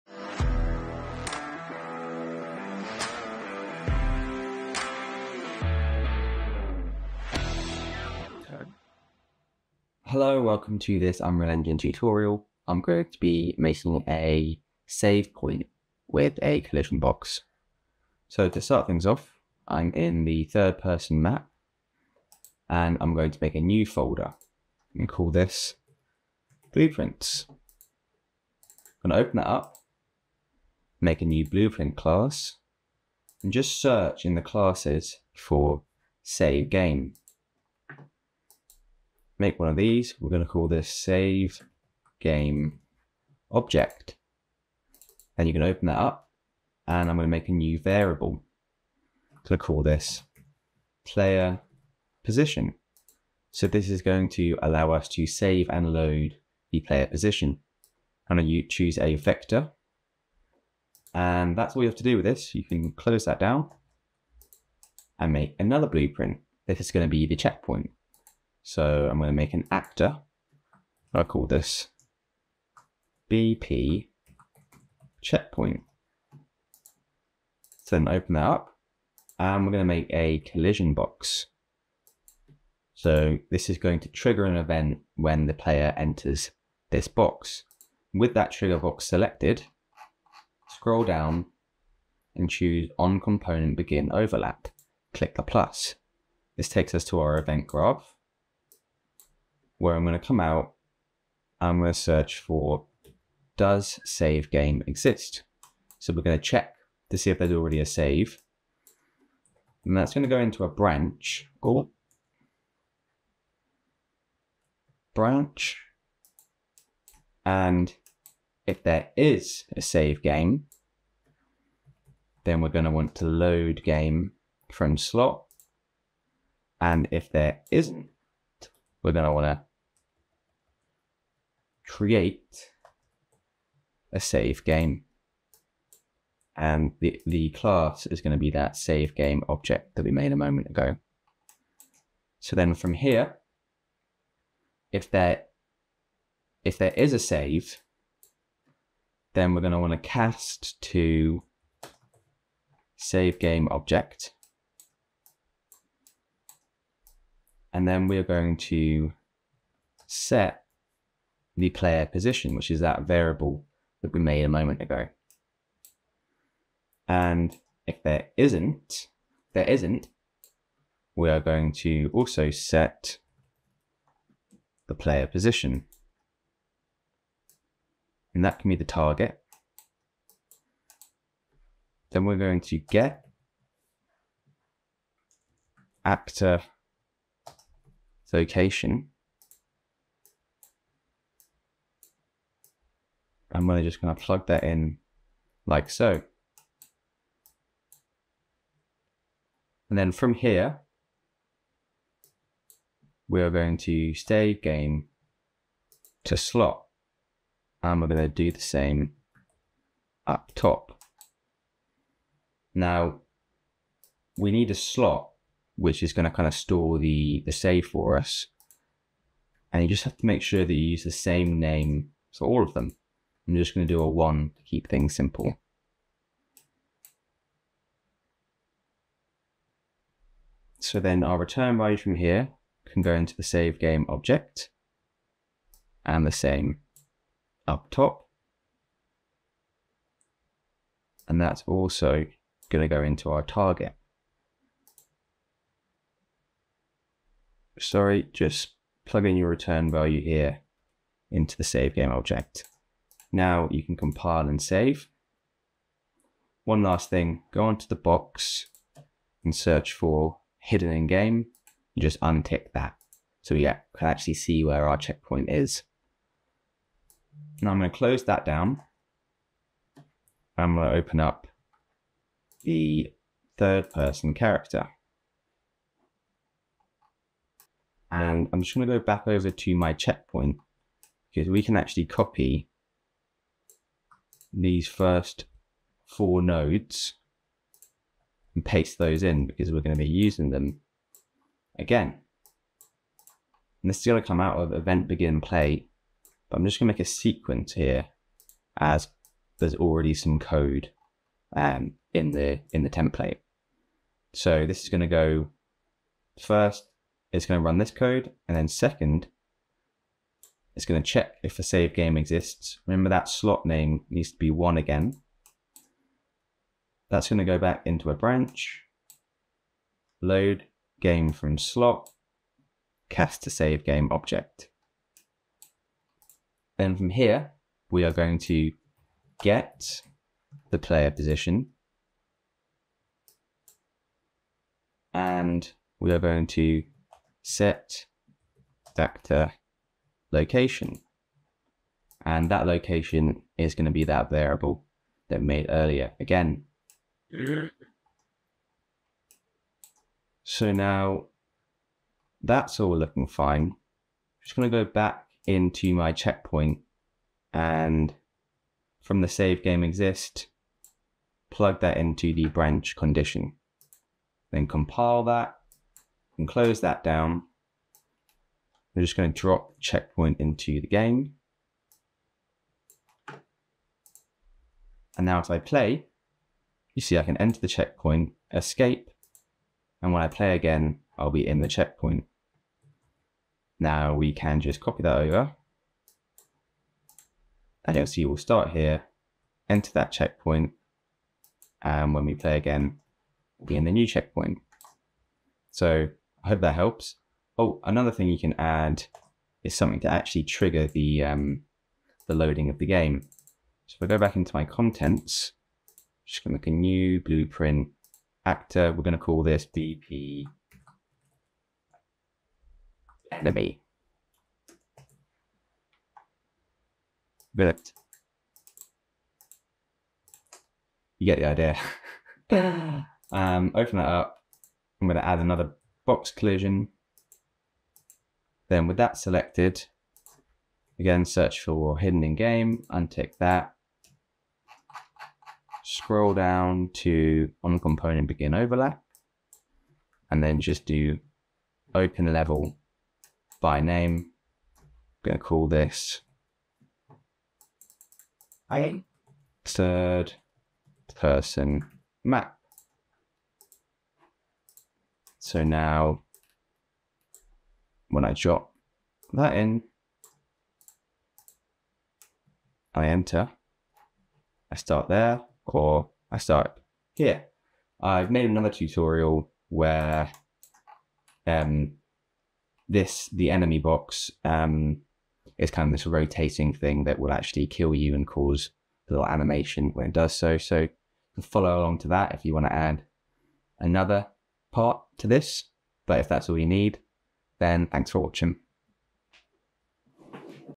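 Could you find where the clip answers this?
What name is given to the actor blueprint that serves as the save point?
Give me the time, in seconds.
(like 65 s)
73 s.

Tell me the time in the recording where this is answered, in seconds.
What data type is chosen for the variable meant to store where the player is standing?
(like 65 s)
59 s.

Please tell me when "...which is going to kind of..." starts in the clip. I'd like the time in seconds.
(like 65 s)
215 s.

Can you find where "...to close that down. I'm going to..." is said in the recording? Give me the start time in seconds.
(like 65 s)
267 s.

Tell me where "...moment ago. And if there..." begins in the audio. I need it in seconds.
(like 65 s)
164 s.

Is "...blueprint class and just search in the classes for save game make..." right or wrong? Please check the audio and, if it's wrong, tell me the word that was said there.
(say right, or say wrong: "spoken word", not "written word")
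right.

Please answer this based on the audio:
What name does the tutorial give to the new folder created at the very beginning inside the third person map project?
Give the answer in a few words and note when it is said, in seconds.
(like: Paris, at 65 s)
blueprints, at 26 s.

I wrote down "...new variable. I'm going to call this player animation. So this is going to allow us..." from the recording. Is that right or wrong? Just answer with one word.
wrong.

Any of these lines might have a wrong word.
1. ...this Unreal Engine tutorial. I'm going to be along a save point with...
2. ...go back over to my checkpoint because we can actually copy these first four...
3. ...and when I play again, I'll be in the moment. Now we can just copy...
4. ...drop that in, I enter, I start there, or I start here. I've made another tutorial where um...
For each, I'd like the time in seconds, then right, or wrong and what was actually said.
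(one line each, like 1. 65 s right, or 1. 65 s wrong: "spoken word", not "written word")
1. 10 s wrong: "making", not "along"
2. 278 s right
3. 380 s wrong: "checkpoint", not "moment"
4. 458 s right.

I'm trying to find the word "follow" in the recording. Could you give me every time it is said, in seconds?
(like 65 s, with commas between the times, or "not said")
481 s.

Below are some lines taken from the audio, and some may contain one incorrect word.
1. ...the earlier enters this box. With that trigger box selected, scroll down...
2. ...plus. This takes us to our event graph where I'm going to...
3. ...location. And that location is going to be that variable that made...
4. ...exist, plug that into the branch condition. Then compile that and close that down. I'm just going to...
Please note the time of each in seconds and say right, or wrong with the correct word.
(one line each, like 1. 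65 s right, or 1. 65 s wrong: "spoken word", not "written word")
1. 85 s wrong: "player", not "earlier"
2. 95 s right
3. 340 s right
4. 359 s right.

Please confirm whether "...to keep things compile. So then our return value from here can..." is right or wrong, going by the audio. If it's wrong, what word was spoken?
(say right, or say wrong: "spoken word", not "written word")
wrong: "simple", not "compile".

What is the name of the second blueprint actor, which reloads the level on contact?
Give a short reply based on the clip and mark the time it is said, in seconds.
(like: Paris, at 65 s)
BP enemy, at 409 s.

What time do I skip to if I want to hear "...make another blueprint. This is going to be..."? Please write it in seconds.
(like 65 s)
65 s.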